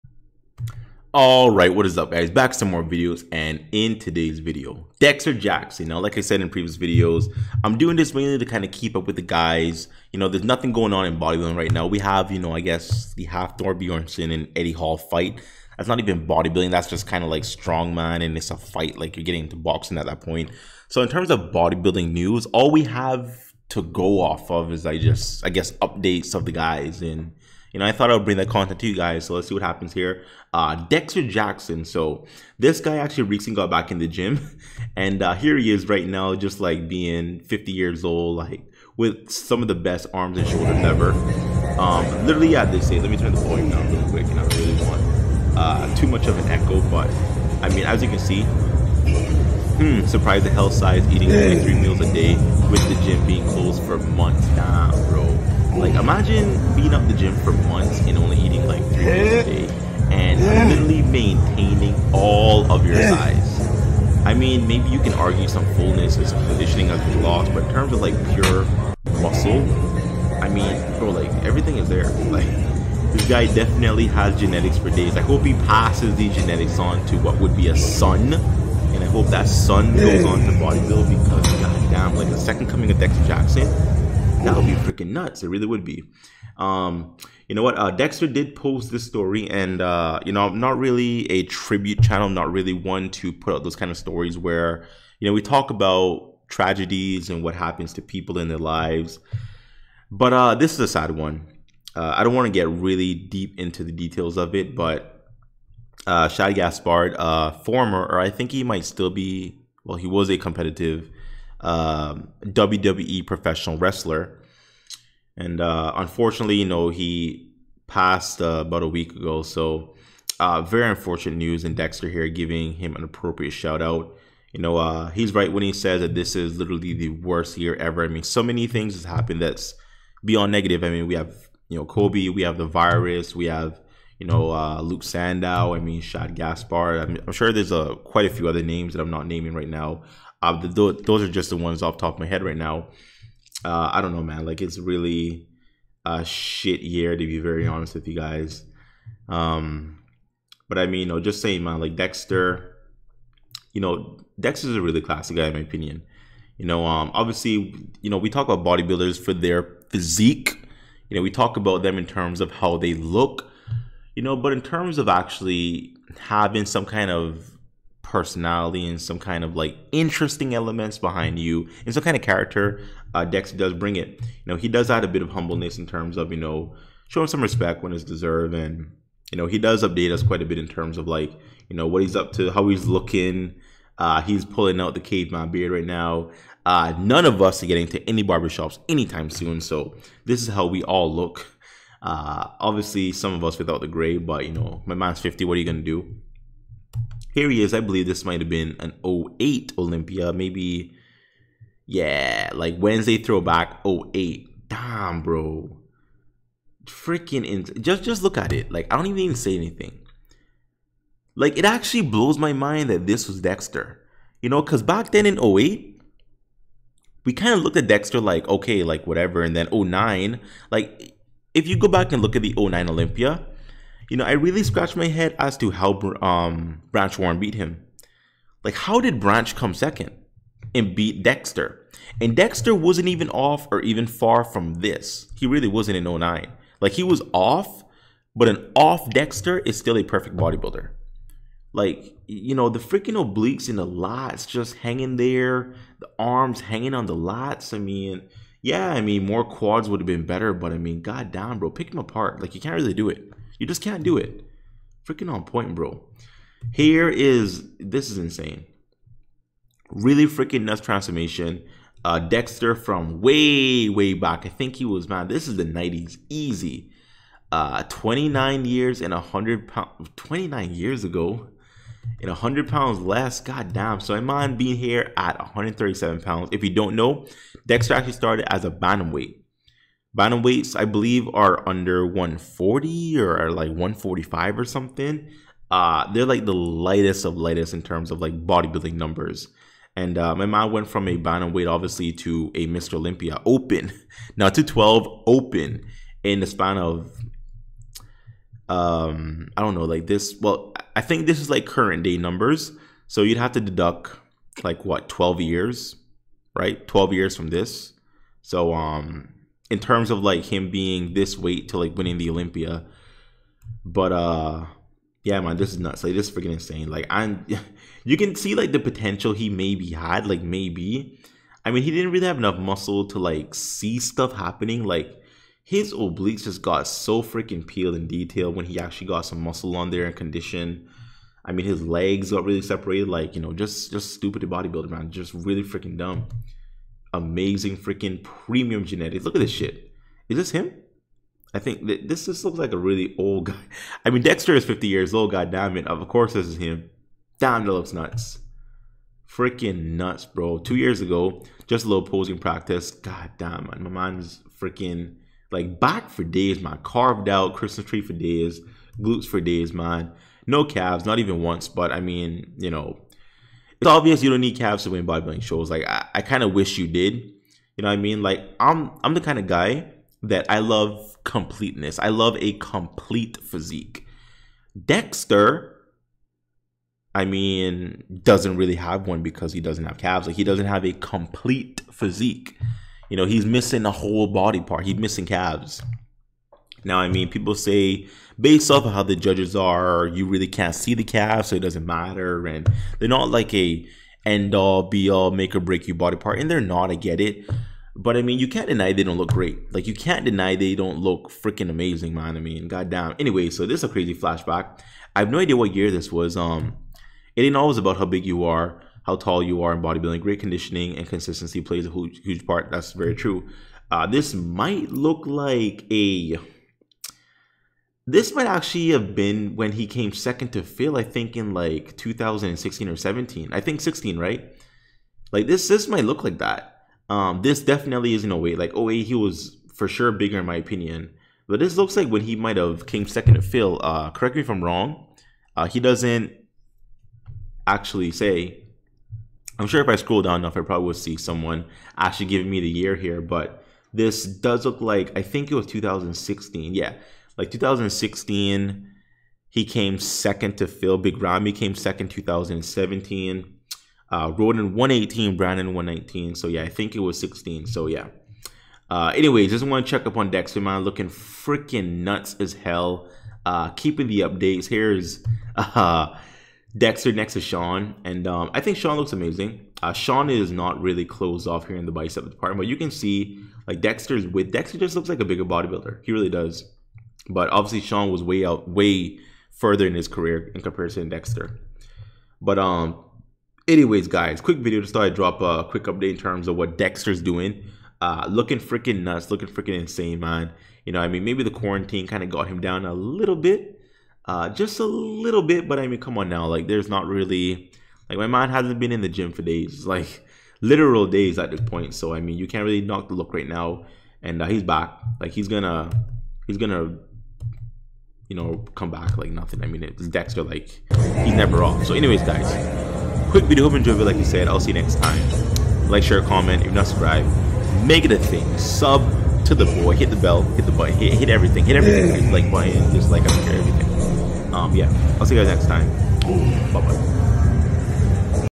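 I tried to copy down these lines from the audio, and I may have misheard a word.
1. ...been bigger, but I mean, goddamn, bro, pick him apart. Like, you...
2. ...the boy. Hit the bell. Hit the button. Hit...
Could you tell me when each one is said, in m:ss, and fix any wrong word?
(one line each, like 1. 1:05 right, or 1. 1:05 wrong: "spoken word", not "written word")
1. 4:10 wrong: "better", not "bigger"
2. 8:39 right.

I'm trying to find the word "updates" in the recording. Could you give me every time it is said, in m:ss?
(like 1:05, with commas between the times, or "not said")
0:25, 2:59, 7:44, 8:05.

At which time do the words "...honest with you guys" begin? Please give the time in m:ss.
2:27.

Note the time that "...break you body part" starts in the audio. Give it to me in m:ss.
6:35.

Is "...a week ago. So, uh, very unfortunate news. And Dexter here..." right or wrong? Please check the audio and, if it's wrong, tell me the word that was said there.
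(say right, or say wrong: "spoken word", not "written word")
right.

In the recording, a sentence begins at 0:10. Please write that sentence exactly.
You know, there's nothing going on in bodybuilding right now.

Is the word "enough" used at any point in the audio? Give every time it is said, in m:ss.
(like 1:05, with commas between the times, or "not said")
5:22, 7:20.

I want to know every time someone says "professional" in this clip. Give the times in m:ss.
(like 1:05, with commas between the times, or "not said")
1:53.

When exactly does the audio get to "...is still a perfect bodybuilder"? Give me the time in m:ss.
3:59.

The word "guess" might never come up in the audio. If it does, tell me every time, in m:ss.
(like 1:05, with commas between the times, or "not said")
0:12, 0:25.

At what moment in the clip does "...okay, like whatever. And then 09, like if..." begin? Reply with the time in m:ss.
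3:38.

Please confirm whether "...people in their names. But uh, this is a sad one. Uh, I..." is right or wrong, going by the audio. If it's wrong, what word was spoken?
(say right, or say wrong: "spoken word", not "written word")
wrong: "lives", not "names".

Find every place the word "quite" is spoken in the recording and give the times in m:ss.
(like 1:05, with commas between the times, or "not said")
2:18, 3:00.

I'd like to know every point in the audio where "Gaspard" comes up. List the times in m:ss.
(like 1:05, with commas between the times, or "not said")
1:46, 2:16.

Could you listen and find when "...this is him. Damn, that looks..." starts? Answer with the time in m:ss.
5:46.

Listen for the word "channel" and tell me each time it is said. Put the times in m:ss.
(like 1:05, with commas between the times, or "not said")
1:32.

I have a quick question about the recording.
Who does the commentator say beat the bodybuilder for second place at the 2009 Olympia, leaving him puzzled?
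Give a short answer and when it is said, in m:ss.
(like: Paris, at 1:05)
Branch Warren, at 3:46.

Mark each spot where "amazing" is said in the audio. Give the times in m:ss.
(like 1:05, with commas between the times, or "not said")
5:37, 6:41, 7:49.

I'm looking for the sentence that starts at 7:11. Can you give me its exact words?
But this looks like when he might have came second to Phil.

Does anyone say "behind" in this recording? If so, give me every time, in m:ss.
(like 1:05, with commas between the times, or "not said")
2:50.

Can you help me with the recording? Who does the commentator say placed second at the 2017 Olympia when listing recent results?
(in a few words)
Big Ramy.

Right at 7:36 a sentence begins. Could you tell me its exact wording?
So yeah, I think it was 16.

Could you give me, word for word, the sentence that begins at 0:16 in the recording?
That's just kind of like strongman and it's a fight.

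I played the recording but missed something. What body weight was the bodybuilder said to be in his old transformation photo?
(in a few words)
137 pounds.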